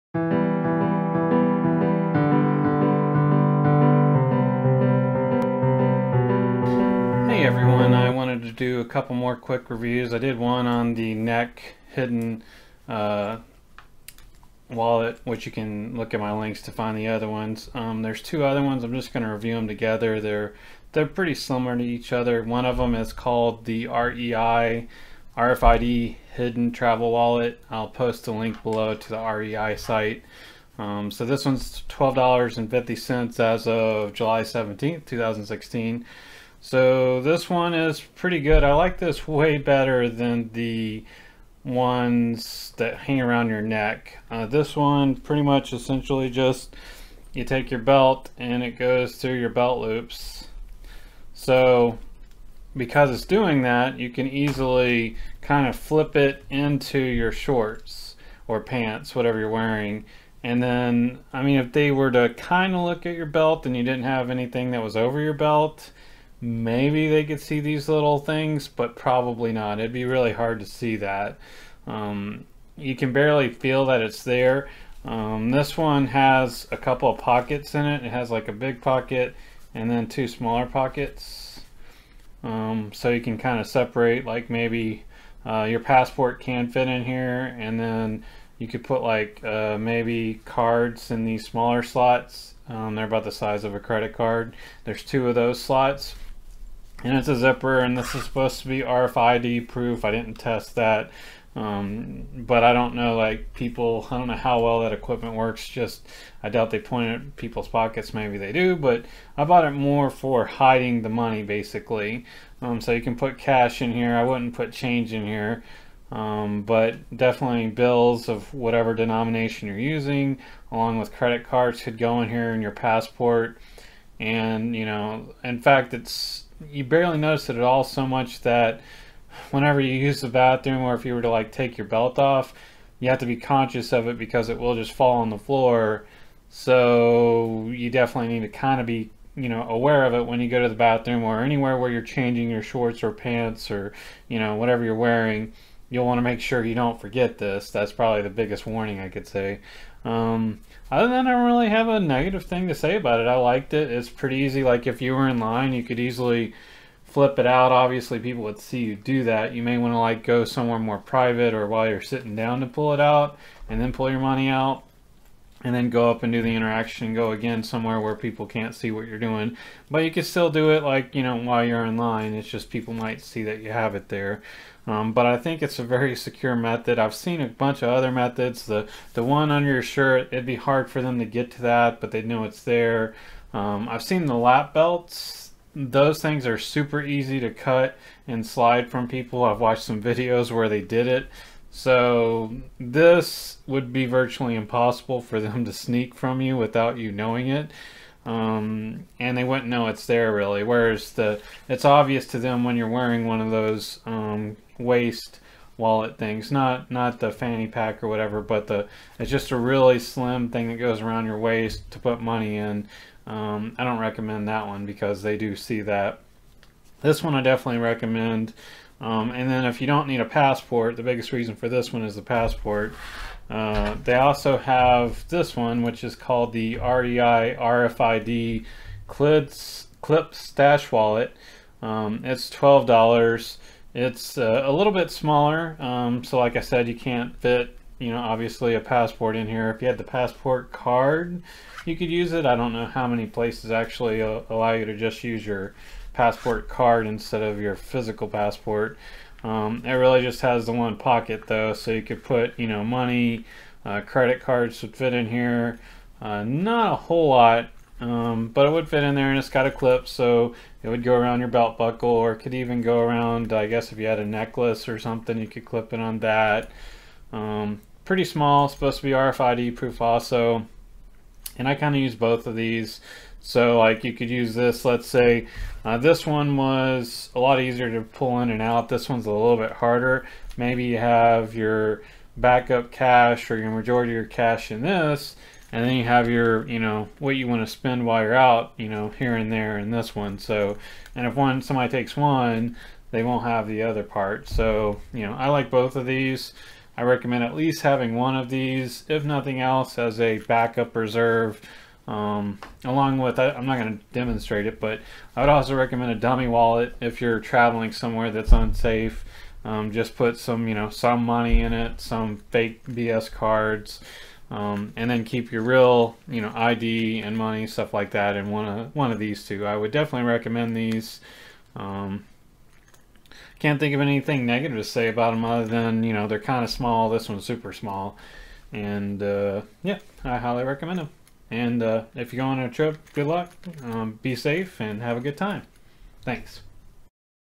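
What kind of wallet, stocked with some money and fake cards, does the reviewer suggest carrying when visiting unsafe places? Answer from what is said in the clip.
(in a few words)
A dummy wallet.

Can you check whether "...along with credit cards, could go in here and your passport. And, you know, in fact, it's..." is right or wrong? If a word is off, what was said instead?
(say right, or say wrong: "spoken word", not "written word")
right.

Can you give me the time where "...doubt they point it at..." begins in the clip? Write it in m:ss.
1:46.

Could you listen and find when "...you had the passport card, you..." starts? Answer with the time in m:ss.
3:59.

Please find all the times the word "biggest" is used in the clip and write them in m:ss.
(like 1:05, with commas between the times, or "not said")
2:28, 3:41.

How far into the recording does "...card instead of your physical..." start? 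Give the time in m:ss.
4:06.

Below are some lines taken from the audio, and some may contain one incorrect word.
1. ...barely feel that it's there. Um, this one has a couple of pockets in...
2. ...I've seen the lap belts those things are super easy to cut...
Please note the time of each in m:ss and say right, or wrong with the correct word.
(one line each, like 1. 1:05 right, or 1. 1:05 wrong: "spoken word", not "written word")
1. 1:13 right
2. 3:03 right.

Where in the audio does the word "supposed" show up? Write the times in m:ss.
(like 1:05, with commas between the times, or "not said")
1:38, 4:28.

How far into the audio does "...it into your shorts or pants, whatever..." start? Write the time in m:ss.
0:56.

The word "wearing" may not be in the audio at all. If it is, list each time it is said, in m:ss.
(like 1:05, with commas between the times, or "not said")
0:59, 2:24, 3:22.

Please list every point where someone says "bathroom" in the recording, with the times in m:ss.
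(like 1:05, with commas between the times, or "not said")
2:10, 2:20.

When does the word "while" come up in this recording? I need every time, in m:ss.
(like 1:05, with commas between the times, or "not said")
2:41, 2:51, 4:48.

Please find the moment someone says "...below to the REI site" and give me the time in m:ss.
0:28.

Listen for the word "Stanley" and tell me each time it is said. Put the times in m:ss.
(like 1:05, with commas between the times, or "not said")
not said.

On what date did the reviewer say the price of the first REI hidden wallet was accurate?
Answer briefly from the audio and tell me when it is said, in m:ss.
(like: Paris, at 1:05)
July 17th, 2016, at 0:34.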